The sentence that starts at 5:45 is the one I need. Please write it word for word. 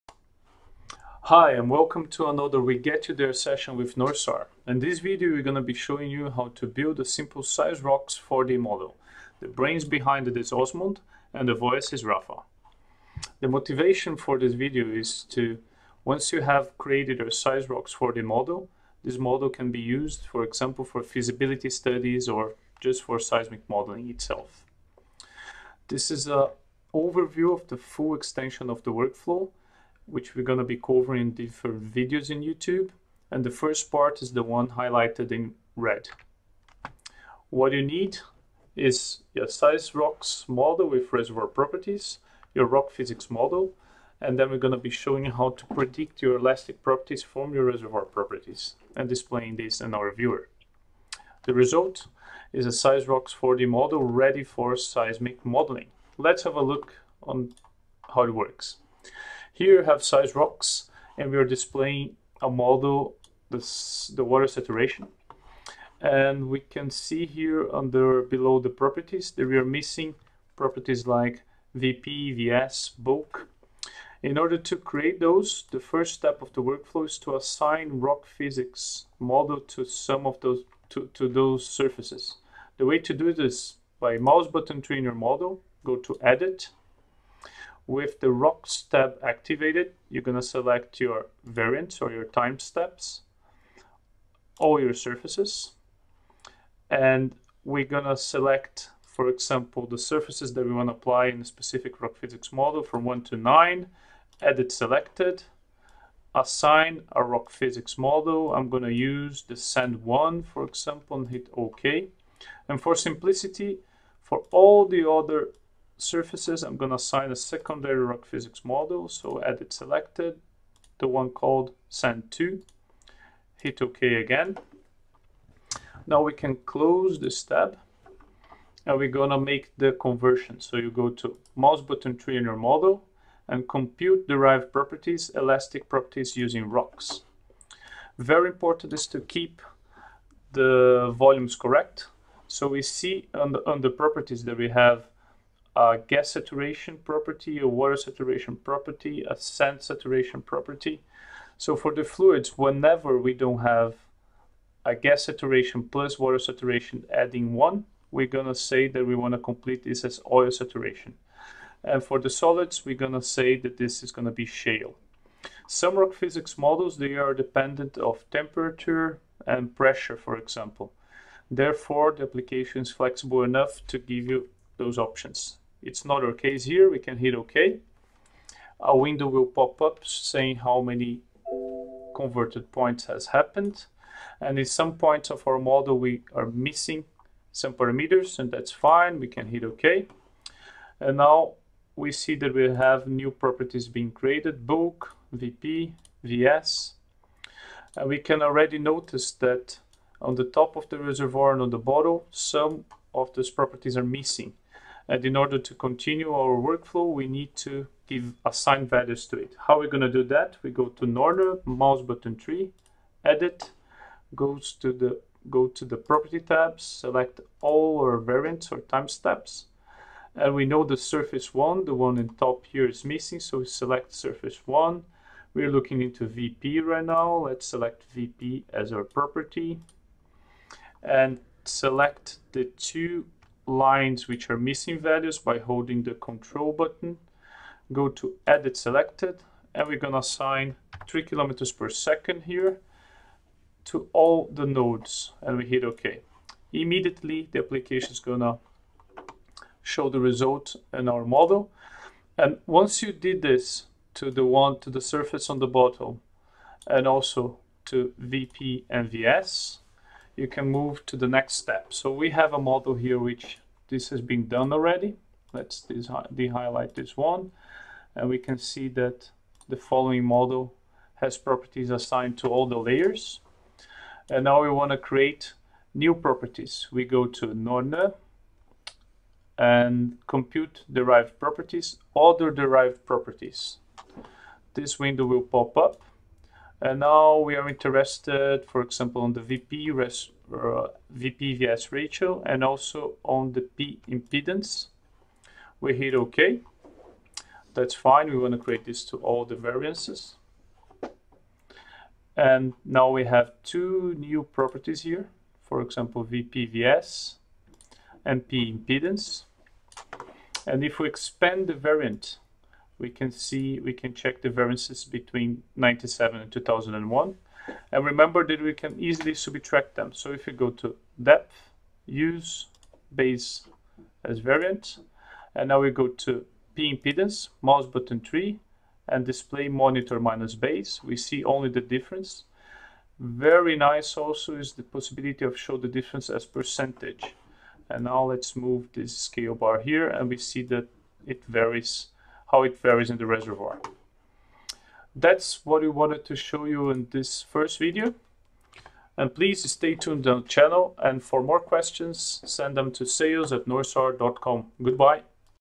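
That's what we wanted to show you in this first video.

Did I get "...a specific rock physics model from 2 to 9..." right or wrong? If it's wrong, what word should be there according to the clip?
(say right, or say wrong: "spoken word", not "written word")
wrong: "1", not "2".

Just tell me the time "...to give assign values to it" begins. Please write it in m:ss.
3:27.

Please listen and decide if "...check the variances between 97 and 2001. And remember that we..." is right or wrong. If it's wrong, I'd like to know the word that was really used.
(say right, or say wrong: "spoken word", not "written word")
right.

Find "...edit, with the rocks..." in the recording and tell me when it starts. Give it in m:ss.
1:26.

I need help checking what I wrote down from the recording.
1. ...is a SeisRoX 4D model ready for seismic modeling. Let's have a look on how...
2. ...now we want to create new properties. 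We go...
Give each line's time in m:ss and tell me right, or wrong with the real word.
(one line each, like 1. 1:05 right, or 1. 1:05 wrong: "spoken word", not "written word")
1. 0:52 right
2. 4:34 right.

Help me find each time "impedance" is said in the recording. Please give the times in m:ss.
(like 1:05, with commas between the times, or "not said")
4:54, 5:08, 5:26.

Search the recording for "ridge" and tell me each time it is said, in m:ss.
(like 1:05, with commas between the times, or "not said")
not said.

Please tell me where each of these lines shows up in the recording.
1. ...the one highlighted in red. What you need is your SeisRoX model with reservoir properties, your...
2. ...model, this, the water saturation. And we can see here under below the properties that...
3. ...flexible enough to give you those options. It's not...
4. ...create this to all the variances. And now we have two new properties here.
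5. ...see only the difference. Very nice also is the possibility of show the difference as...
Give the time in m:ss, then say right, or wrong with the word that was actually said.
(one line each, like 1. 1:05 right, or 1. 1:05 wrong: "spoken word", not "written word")
1. 0:34 right
2. 1:02 right
3. 2:52 right
4. 4:58 right
5. 5:31 right.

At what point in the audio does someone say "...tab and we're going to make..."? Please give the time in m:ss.
2:07.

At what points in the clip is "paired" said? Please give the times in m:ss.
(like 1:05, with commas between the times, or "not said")
not said.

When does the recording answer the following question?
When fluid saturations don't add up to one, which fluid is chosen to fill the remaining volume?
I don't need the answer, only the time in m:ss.
2:40.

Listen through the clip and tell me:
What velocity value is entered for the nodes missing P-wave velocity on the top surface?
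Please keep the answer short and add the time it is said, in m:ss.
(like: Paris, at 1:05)
3 kilometers per second, at 4:01.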